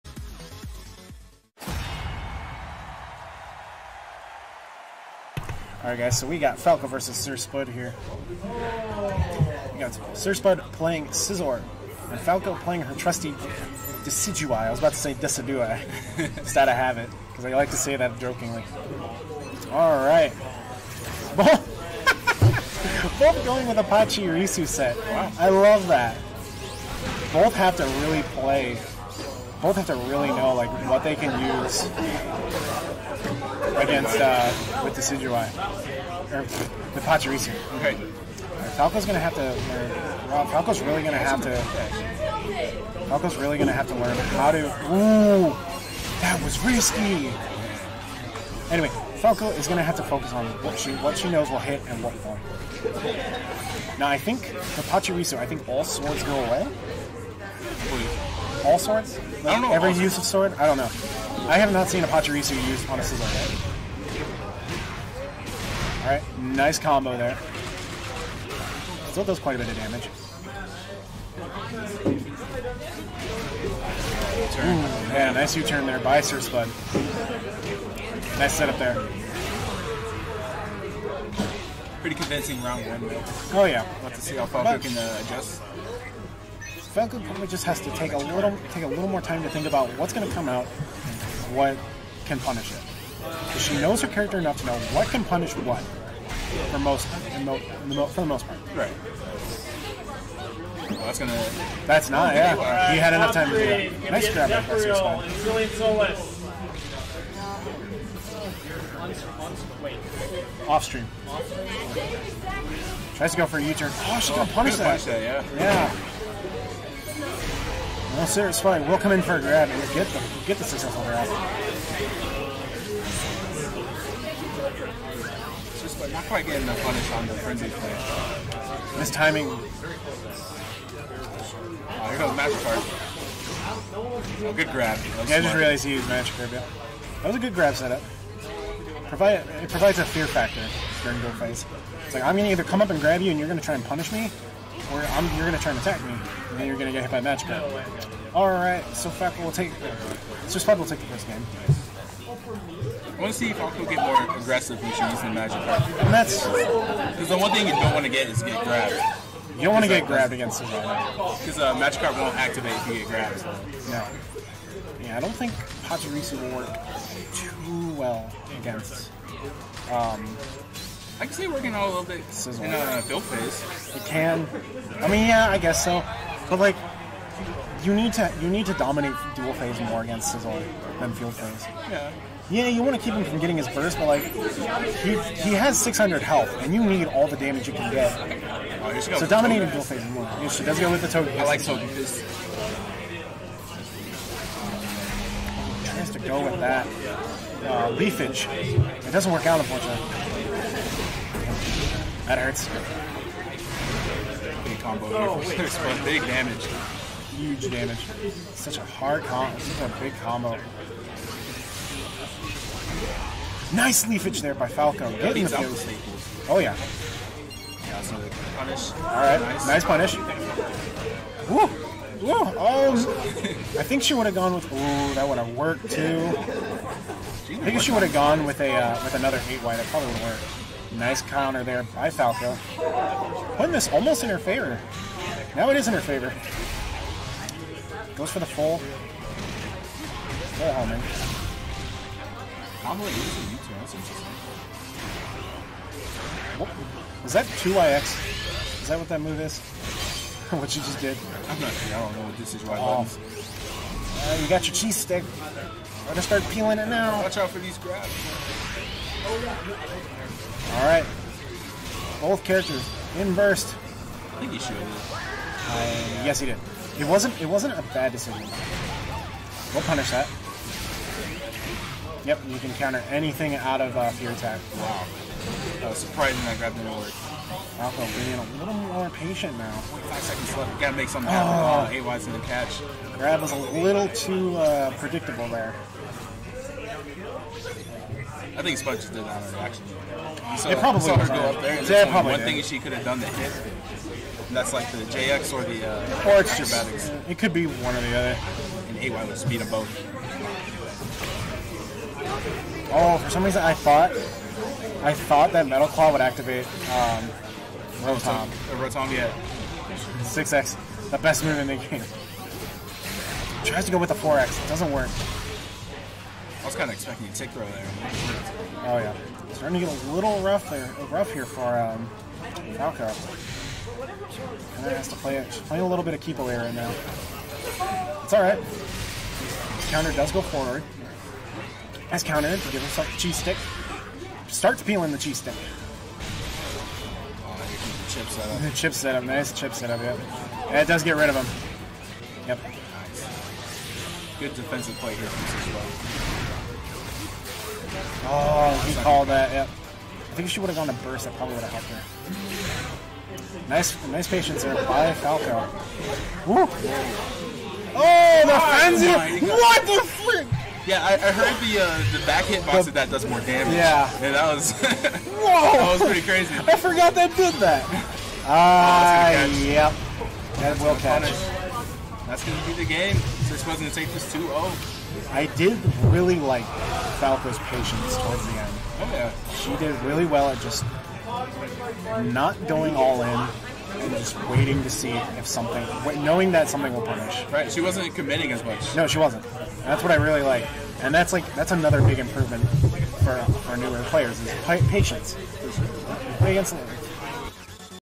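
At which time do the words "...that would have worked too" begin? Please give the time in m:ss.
3:45.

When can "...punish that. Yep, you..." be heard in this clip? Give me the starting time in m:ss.
4:29.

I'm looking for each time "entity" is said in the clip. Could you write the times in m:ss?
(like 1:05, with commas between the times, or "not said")
not said.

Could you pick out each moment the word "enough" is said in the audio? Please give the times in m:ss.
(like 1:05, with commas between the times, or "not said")
1:34, 1:43.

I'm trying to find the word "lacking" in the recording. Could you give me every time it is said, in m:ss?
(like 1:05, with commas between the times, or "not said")
not said.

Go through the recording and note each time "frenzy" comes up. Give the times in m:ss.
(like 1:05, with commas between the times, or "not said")
2:07, 5:58.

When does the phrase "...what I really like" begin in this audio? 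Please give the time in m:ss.
6:30.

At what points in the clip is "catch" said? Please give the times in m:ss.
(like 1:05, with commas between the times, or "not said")
4:42, 6:10.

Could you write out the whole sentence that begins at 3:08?
Oh, so dominating duel phase more.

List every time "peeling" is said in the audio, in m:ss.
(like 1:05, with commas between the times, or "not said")
4:16, 5:34.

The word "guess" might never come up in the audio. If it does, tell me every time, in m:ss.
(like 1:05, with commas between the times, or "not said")
2:55.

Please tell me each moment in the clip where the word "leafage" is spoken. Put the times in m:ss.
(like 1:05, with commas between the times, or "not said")
3:17, 3:34.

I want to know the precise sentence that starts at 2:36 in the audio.
Because the one thing you don't want to get is get grabbed.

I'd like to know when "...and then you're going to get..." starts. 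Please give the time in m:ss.
2:26.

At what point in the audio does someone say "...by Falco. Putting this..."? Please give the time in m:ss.
3:51.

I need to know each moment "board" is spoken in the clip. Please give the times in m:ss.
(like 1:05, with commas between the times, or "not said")
not said.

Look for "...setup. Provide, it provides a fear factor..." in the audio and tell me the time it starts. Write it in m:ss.
2:17.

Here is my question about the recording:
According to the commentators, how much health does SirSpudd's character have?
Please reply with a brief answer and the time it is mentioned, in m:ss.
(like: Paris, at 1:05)
600, at 3:05.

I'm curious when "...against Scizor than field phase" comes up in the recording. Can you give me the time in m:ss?
3:00.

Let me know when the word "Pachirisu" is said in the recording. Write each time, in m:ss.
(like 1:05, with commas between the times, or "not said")
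0:23, 0:37, 0:54, 1:02, 2:45.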